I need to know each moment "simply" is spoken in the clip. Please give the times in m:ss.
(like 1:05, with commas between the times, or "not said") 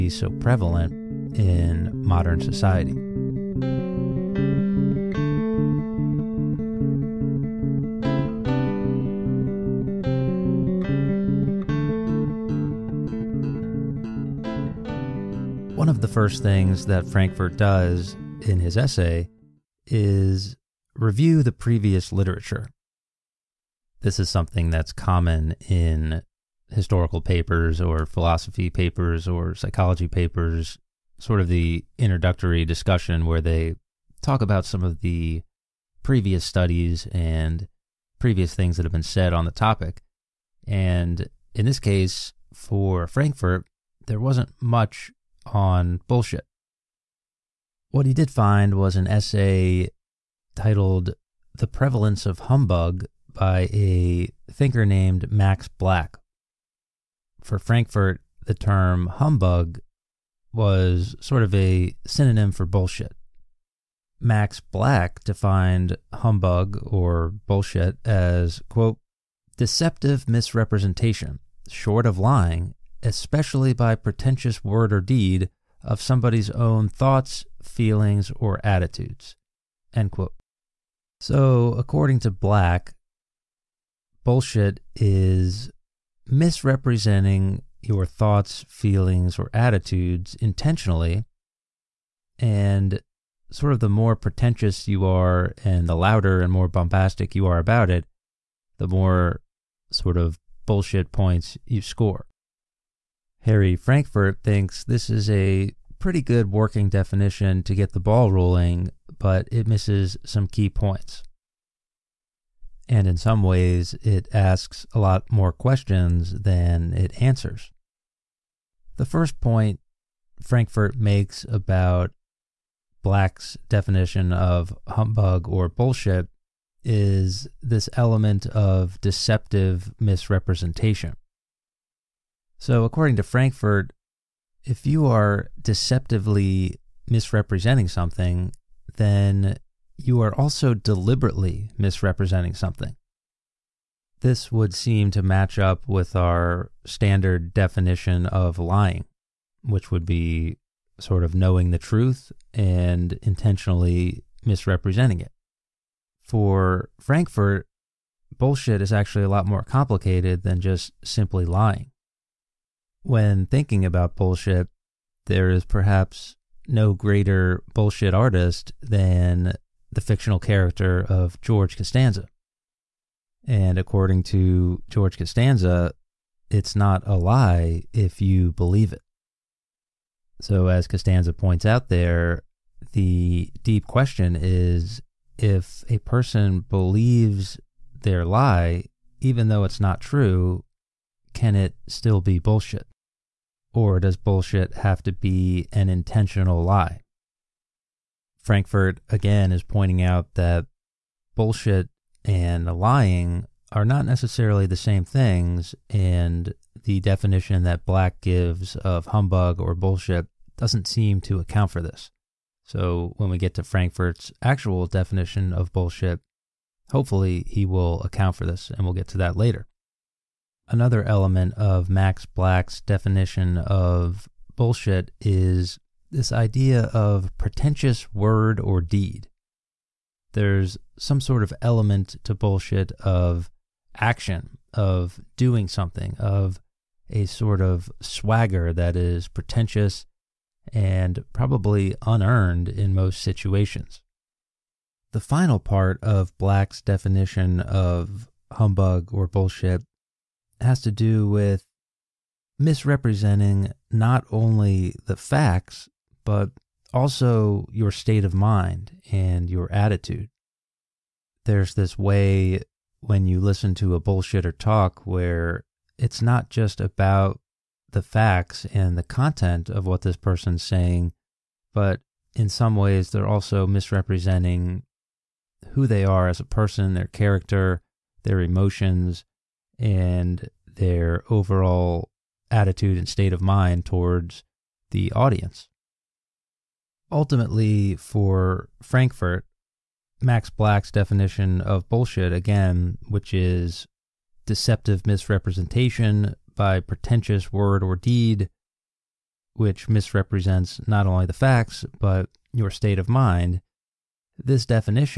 2:41.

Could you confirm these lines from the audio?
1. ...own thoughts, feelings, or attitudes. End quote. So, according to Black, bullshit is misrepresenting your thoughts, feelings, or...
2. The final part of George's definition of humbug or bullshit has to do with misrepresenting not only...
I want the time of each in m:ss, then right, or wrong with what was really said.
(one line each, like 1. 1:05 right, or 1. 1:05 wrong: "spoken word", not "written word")
1. 1:16 right
2. 4:05 wrong: "Black", not "George".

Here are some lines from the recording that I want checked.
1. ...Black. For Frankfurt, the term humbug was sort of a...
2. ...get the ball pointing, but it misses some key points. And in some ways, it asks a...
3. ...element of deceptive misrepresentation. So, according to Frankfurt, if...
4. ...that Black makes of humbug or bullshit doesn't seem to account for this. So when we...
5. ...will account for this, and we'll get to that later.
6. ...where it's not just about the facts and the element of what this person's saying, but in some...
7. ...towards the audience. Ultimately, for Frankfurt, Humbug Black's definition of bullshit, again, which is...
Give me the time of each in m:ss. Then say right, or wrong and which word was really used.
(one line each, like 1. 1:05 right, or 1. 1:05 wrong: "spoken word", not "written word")
1. 0:55 right
2. 1:47 wrong: "rolling", not "pointing"
3. 2:07 right
4. 3:27 wrong: "gives", not "makes"
5. 3:37 right
6. 4:25 wrong: "content", not "element"
7. 4:43 wrong: "Max", not "Humbug".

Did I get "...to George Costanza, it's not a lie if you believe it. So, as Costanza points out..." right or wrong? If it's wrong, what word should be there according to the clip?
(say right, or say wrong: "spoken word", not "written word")
right.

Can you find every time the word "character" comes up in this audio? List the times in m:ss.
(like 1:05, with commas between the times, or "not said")
2:50, 4:37.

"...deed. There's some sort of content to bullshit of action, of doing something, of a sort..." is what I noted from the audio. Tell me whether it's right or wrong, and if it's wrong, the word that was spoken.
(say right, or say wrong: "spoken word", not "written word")
wrong: "element", not "content".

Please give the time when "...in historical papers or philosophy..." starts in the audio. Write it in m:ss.
0:25.